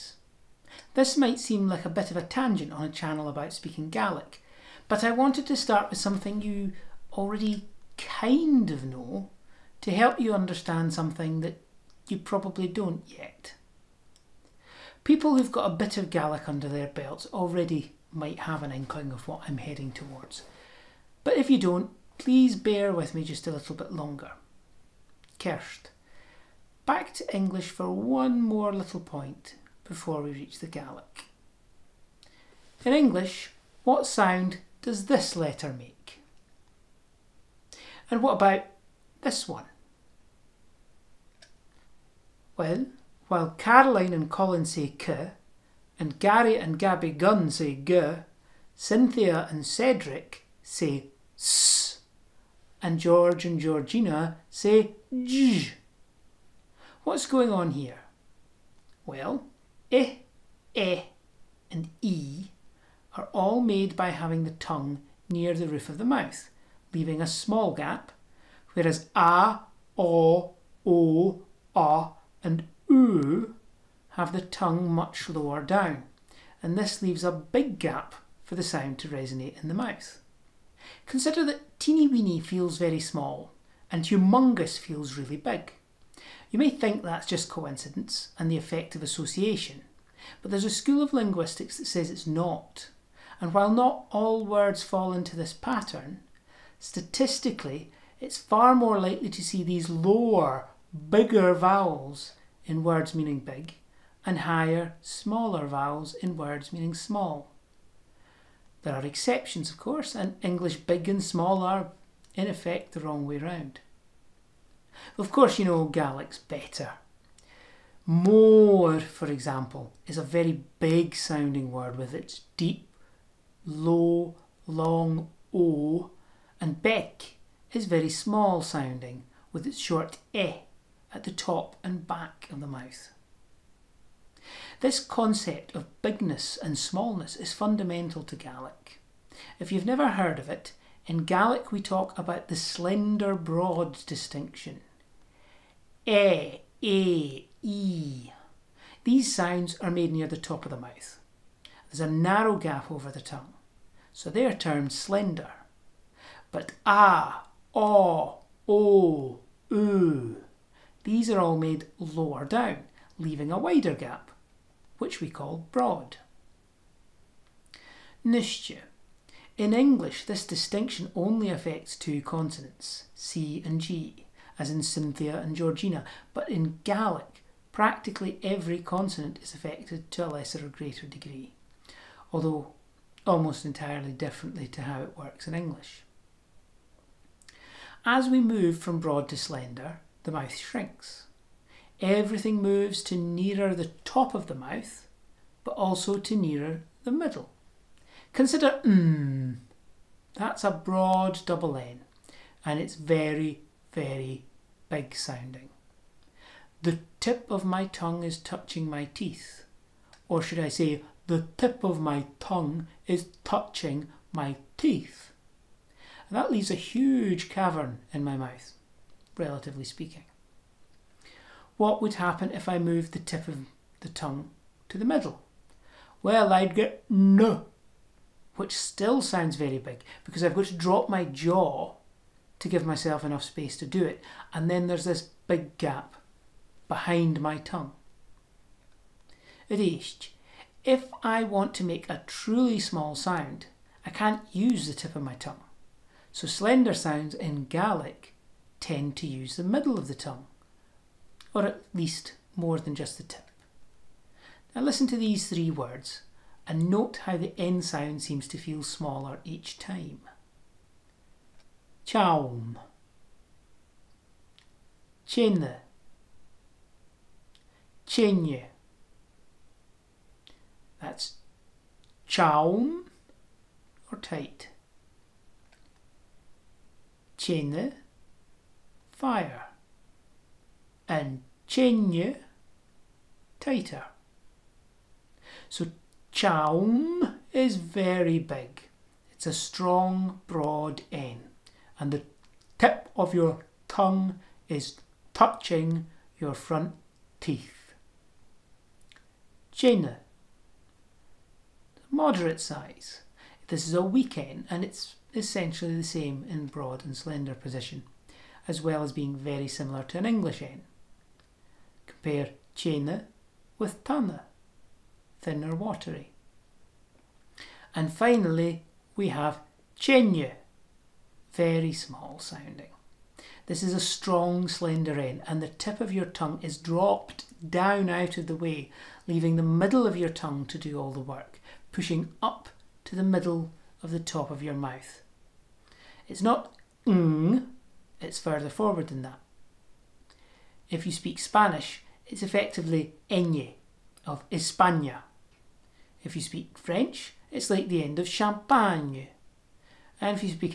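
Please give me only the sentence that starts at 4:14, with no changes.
Now listen to these three words and note how the N sound seems to feel smaller each time.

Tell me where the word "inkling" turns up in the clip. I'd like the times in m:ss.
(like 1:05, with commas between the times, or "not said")
0:18.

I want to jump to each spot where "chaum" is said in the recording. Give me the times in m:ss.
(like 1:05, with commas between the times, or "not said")
4:22, 4:32, 4:46.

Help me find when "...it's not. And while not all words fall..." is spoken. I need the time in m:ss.
1:32.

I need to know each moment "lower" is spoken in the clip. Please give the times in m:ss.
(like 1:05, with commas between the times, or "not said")
1:15, 1:39, 2:41.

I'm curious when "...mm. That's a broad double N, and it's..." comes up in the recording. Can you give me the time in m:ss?
3:18.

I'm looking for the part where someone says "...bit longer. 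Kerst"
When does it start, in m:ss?
0:23.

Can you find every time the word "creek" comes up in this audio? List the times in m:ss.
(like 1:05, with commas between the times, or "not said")
not said.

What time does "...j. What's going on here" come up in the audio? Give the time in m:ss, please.
0:55.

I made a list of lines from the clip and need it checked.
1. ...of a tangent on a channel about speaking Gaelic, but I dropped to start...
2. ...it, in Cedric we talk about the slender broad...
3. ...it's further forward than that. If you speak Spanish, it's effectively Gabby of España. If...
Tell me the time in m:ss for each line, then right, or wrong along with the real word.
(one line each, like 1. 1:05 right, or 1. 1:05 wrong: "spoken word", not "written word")
1. 0:02 wrong: "wanted", not "dropped"
2. 2:20 wrong: "Gaelic", not "Cedric"
3. 5:38 wrong: "Eñe", not "Gabby".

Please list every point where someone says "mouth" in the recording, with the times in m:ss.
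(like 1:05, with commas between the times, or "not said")
1:06, 1:19, 2:12, 2:30, 3:10, 3:14, 3:38, 5:34.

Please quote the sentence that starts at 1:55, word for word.
Of course, you know Gaelic's better.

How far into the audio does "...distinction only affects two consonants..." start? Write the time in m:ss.
2:50.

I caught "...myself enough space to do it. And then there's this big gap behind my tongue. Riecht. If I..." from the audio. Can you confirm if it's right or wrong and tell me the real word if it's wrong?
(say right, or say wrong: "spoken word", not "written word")
right.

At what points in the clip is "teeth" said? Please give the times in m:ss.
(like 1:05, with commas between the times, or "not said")
3:29, 3:34, 4:57.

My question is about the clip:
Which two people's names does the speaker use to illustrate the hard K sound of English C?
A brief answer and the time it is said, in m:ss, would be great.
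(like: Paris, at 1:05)
Caroline and Colin, at 0:43.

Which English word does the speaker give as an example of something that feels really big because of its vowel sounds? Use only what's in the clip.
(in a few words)
humongous.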